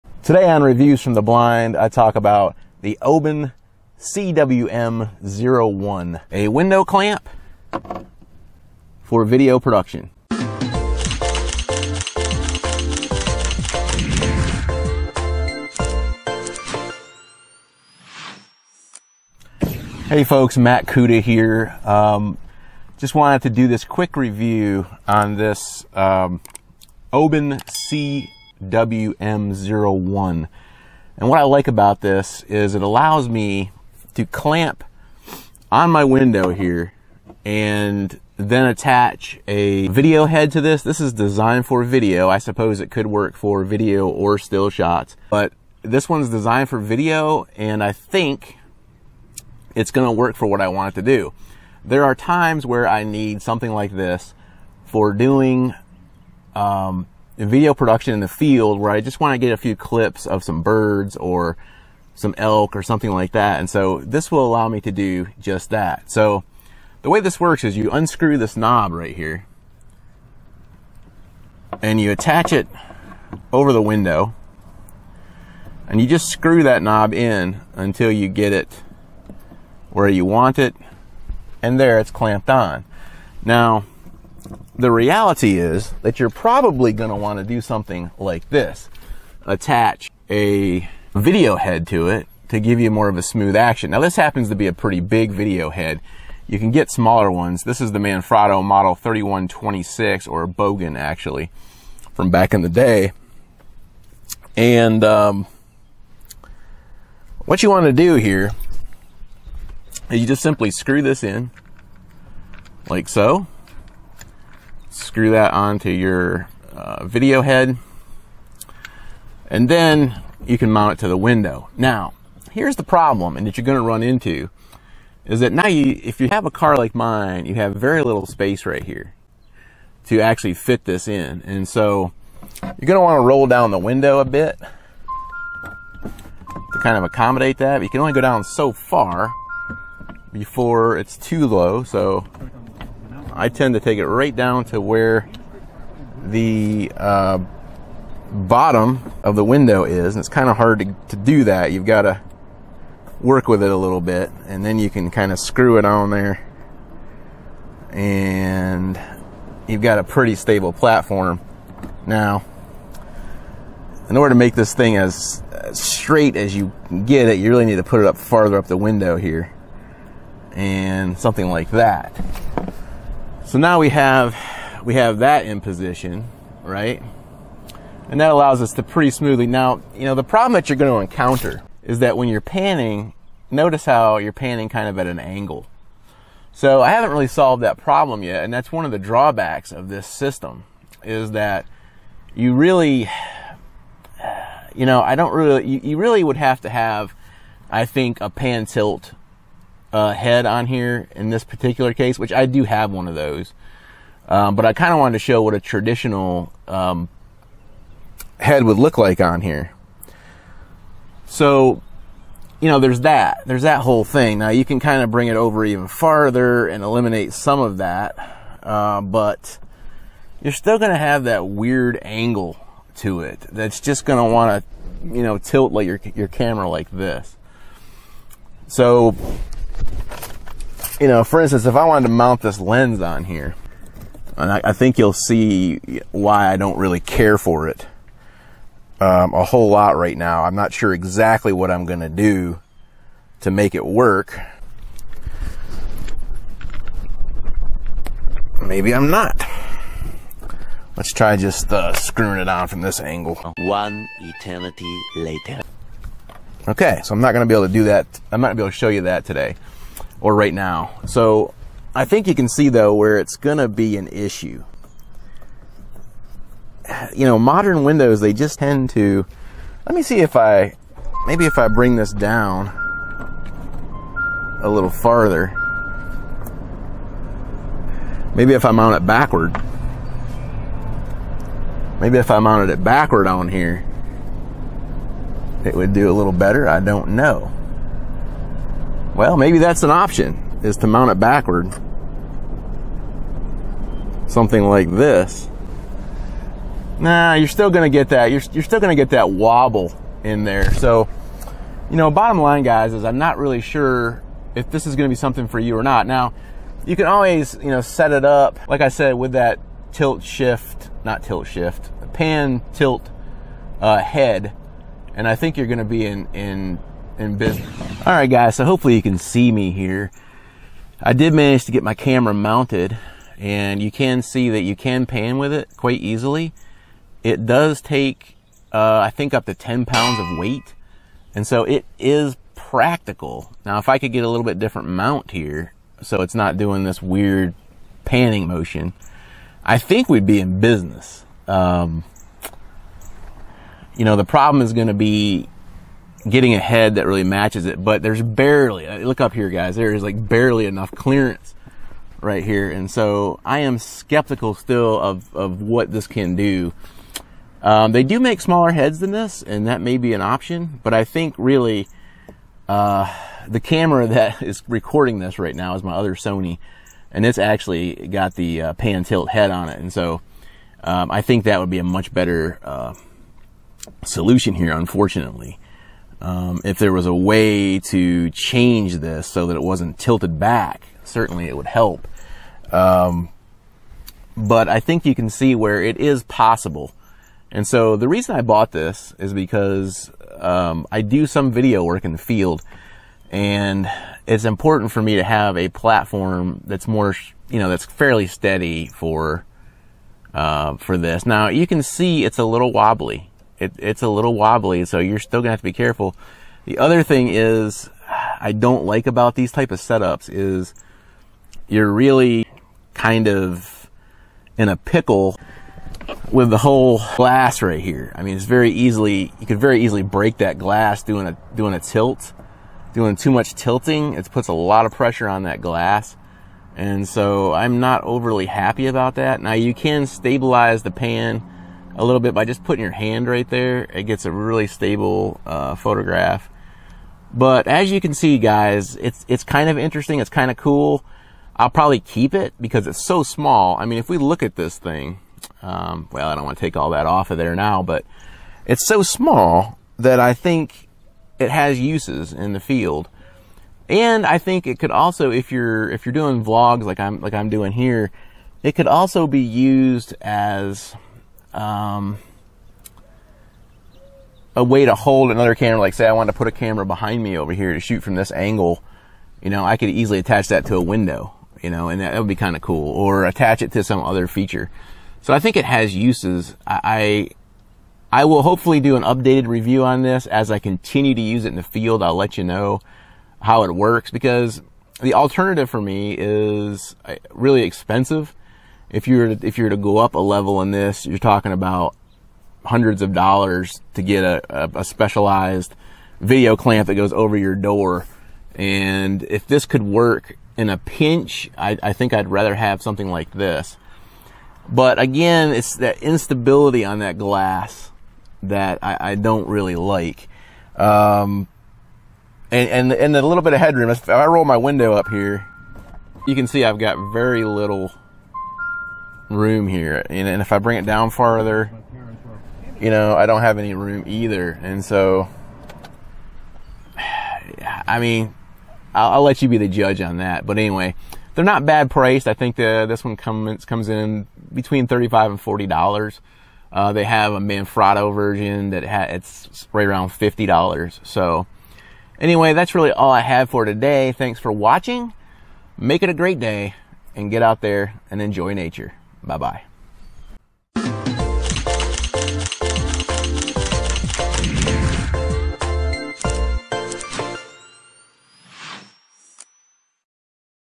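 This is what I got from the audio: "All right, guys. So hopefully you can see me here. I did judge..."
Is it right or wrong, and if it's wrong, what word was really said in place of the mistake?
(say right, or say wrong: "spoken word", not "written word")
wrong: "manage", not "judge".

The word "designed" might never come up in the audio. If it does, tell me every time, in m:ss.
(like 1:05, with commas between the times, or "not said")
0:41, 0:46.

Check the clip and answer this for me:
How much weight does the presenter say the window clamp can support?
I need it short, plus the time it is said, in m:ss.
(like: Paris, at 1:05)
10 pounds, at 5:29.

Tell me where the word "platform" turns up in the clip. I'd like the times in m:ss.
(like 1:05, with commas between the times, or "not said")
2:40, 6:35.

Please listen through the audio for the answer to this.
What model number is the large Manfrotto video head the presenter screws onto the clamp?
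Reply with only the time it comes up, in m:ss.
1:38.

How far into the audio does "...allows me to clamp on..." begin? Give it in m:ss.
0:32.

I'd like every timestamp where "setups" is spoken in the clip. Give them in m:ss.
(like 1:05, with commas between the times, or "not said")
6:49.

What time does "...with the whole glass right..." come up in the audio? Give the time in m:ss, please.
6:56.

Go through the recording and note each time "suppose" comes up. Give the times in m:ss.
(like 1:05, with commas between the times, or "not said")
0:42.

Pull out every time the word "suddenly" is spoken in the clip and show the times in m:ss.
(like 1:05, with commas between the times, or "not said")
not said.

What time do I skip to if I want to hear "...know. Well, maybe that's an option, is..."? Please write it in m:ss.
4:47.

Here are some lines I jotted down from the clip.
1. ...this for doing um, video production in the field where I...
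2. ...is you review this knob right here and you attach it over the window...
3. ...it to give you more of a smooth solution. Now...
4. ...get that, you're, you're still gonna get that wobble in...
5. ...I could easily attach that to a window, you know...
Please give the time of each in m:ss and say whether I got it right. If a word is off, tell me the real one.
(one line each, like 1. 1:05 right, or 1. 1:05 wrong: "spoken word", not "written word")
1. 0:53 right
2. 1:07 wrong: "unscrew", not "review"
3. 1:32 wrong: "action", not "solution"
4. 4:57 right
5. 7:49 right.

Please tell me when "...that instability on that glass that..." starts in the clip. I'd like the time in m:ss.
8:25.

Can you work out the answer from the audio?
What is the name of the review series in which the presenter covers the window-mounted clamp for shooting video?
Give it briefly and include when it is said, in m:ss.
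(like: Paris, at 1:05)
Reviews from the Blind, at 0:00.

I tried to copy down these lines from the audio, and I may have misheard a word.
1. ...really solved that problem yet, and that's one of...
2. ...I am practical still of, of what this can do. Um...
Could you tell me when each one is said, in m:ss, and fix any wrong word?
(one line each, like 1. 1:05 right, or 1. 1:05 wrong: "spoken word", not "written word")
1. 3:07 right
2. 5:53 wrong: "skeptical", not "practical".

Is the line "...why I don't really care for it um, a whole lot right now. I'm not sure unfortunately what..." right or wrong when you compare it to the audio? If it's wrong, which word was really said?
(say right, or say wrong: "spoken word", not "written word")
wrong: "exactly", not "unfortunately".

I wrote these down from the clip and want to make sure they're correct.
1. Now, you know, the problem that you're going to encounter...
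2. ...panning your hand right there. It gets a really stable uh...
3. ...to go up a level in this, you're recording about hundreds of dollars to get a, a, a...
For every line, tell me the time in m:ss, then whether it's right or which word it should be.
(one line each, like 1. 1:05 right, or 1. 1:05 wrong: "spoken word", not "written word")
1. 2:59 right
2. 7:12 wrong: "putting", not "panning"
3. 8:09 wrong: "talking", not "recording".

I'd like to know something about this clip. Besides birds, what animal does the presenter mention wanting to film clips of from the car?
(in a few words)
elk.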